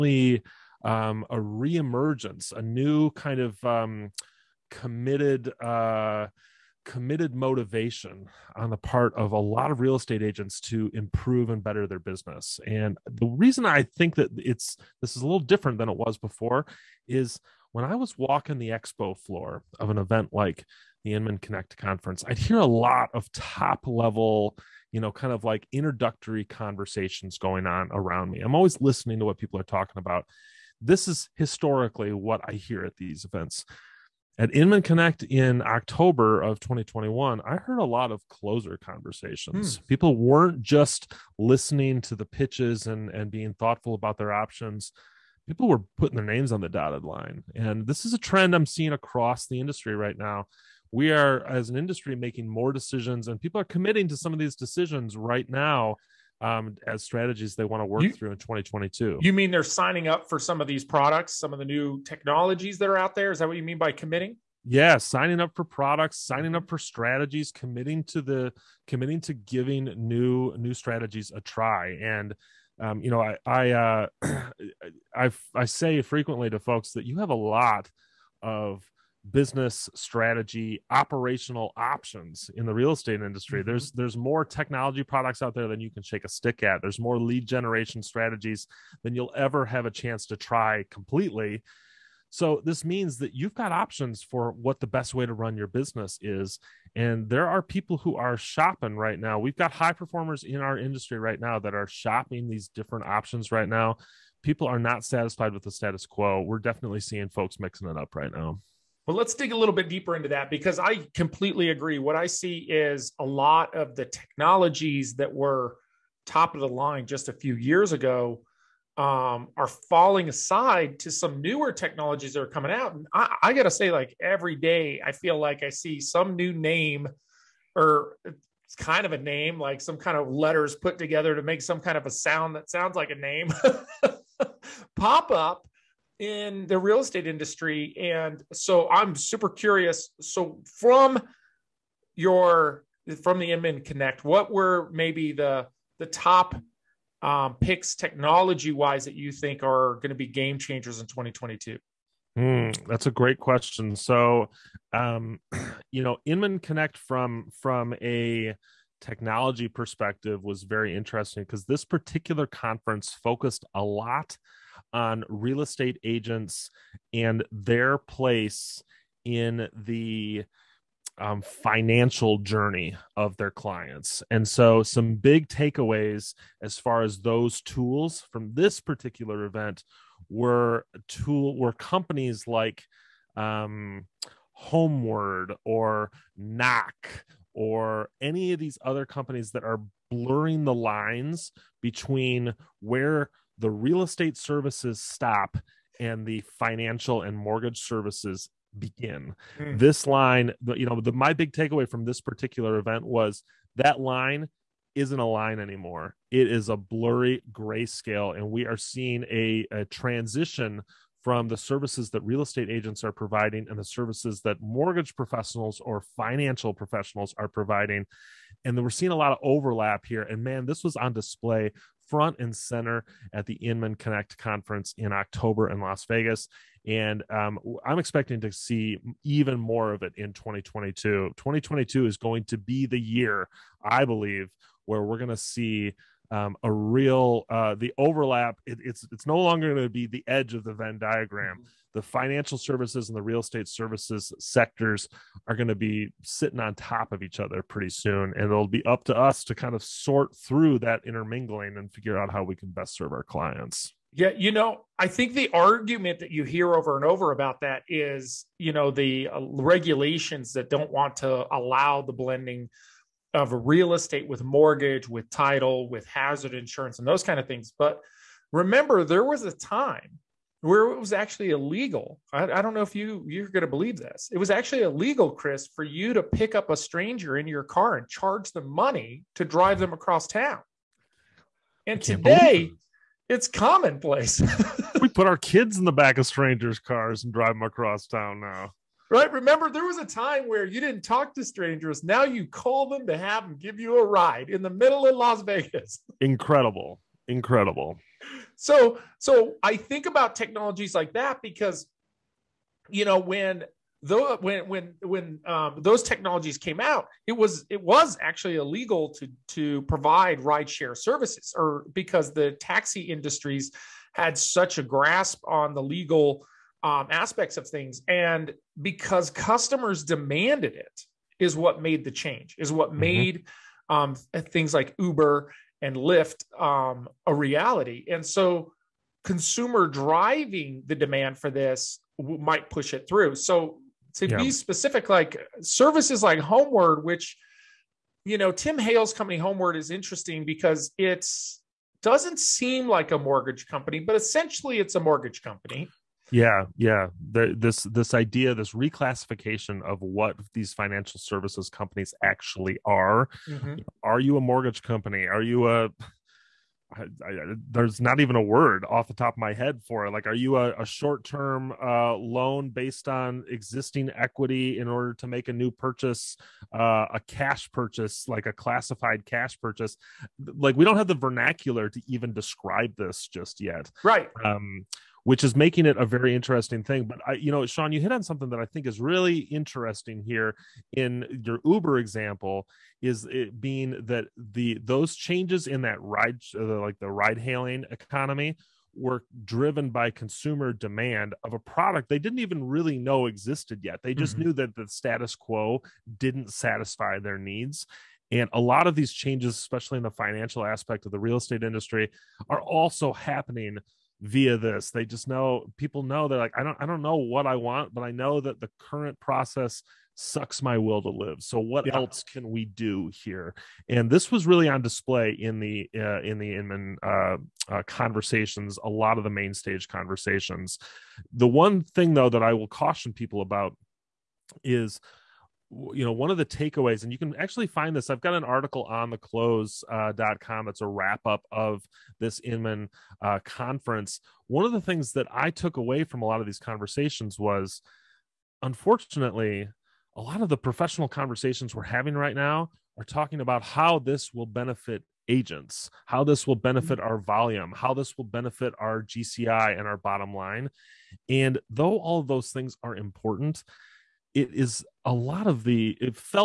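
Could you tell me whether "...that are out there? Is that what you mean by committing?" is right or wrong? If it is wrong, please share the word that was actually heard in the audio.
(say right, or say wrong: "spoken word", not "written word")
right.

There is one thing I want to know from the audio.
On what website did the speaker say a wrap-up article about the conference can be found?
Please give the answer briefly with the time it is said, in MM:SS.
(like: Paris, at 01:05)
the close.com, at 07:09.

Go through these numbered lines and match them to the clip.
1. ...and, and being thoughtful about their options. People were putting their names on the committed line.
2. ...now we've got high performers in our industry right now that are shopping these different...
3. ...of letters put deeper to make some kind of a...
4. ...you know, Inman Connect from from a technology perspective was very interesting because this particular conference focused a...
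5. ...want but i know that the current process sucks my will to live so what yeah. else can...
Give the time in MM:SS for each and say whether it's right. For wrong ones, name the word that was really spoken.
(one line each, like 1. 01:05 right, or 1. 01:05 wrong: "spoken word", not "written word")
1. 00:42 wrong: "dotted", not "committed"
2. 01:39 right
3. 02:10 wrong: "together", not "deeper"
4. 02:35 right
5. 06:47 right.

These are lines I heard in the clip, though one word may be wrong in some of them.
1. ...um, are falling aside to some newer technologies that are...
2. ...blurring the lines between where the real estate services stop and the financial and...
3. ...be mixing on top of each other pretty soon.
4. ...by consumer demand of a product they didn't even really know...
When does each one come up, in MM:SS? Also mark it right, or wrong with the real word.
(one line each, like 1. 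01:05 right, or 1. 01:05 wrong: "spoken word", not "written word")
1. 01:58 right
2. 03:10 right
3. 04:05 wrong: "sitting", not "mixing"
4. 06:29 right.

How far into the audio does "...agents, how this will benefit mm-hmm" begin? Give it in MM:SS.
07:25.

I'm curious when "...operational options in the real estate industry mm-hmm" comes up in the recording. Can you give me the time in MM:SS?
01:20.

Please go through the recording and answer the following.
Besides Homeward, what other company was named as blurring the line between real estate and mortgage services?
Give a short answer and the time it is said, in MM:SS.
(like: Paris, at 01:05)
Knock, at 03:06.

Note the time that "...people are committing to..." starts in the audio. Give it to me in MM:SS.
00:53.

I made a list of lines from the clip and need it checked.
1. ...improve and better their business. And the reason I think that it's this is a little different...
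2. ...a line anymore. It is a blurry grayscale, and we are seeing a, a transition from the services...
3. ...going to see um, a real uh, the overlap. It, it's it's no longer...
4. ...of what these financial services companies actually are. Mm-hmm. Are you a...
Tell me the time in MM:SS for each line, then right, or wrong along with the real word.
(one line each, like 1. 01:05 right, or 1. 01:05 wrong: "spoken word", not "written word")
1. 00:10 right
2. 03:25 right
3. 03:55 right
4. 05:49 right.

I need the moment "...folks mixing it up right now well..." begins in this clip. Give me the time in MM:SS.
01:47.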